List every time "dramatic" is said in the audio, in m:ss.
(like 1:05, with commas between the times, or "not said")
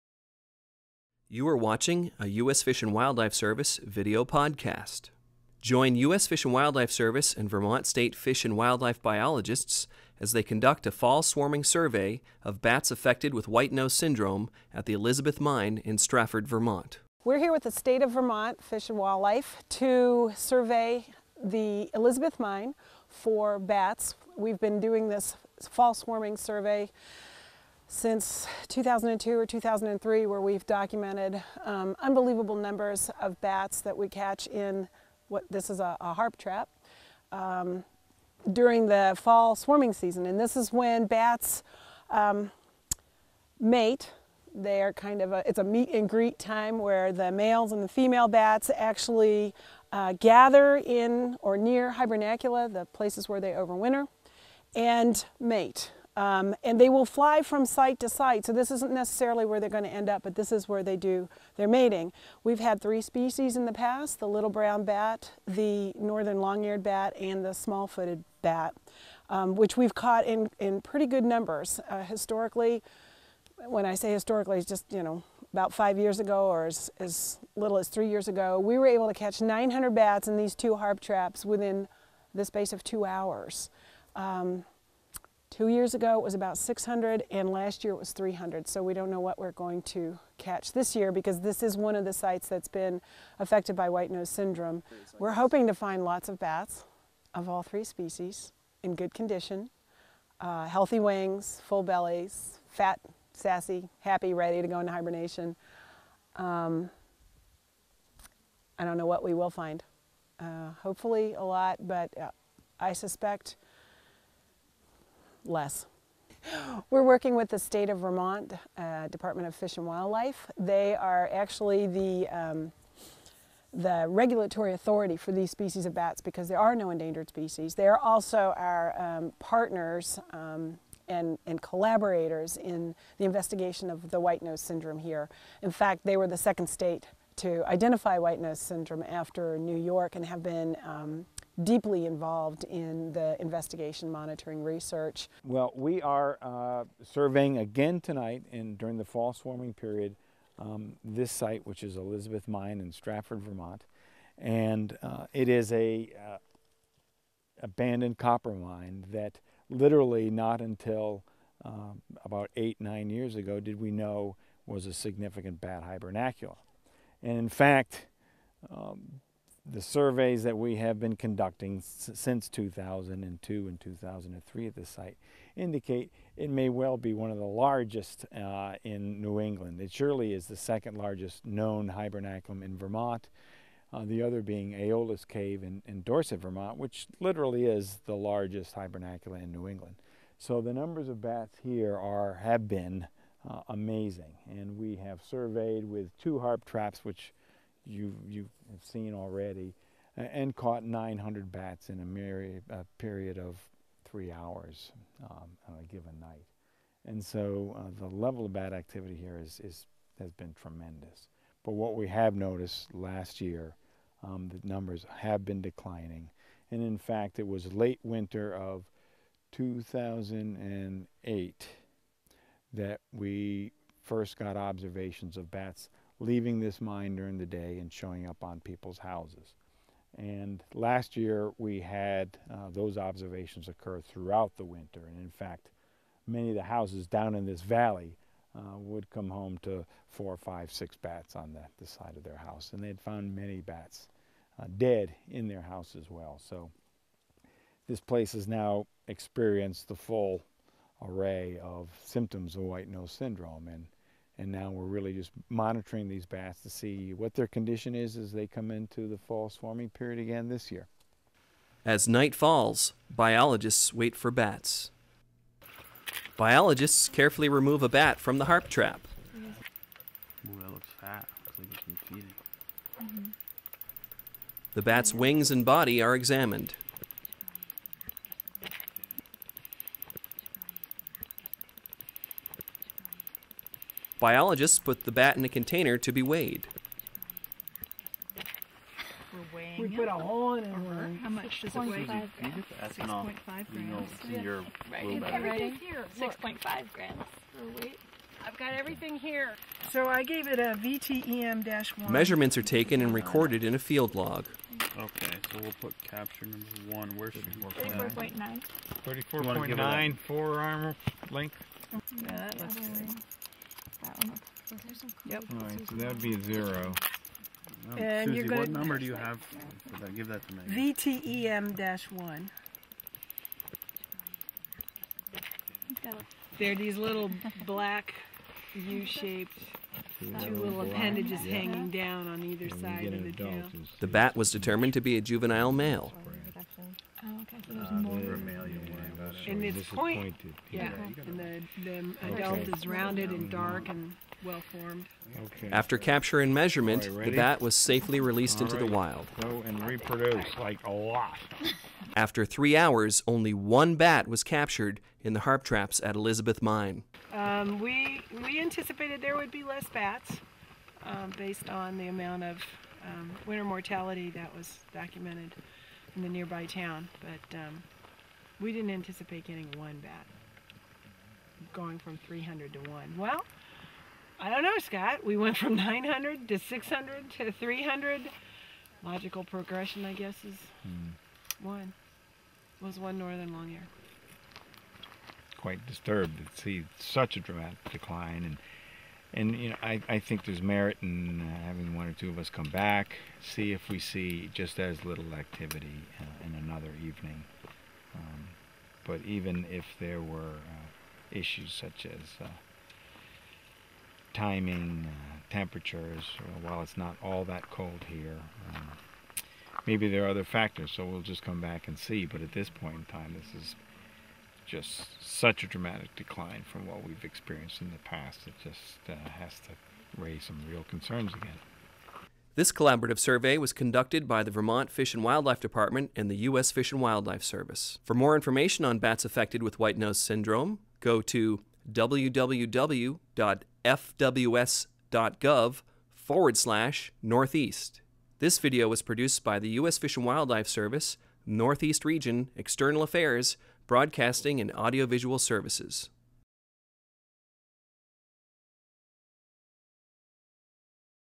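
6:27, 6:55.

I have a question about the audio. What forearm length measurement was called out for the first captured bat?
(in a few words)
34.9.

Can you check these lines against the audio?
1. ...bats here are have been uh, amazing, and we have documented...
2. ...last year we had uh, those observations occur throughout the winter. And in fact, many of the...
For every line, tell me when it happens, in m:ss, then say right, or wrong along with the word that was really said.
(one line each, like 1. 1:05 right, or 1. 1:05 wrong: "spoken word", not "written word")
1. 3:11 wrong: "surveyed", not "documented"
2. 3:50 right.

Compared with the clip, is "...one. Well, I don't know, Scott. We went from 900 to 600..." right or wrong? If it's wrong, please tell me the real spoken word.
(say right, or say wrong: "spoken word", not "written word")
right.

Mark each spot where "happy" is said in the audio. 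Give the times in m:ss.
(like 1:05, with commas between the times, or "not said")
1:43.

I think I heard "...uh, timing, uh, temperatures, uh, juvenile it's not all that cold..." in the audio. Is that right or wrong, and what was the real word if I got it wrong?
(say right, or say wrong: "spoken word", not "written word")
wrong: "while", not "juvenile".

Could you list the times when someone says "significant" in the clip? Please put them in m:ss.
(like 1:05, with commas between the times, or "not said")
2:44.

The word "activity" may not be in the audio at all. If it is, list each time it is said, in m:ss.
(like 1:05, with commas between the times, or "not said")
3:28, 6:35.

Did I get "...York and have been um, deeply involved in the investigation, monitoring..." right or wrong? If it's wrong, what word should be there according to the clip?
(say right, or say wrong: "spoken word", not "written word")
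right.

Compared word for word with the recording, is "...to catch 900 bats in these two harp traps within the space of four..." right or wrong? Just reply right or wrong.
wrong.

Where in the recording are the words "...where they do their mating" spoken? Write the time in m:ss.
1:00.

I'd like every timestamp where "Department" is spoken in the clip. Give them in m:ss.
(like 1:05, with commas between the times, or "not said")
1:59, 7:05.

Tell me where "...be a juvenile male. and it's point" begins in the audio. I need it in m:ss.
5:35.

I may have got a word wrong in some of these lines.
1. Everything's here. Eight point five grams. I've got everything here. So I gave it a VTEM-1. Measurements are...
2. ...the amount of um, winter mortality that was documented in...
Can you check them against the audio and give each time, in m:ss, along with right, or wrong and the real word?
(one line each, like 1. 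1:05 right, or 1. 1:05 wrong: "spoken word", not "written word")
1. 4:55 wrong: "Six", not "Eight"
2. 6:01 right.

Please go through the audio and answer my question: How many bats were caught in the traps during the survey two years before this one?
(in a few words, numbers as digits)
600.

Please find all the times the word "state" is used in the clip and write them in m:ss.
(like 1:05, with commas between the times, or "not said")
0:07, 0:17, 1:57, 2:16.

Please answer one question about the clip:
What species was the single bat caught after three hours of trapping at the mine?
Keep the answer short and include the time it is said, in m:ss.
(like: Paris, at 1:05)
Northern long-eared bat, at 6:23.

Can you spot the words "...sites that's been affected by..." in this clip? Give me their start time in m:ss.
1:32.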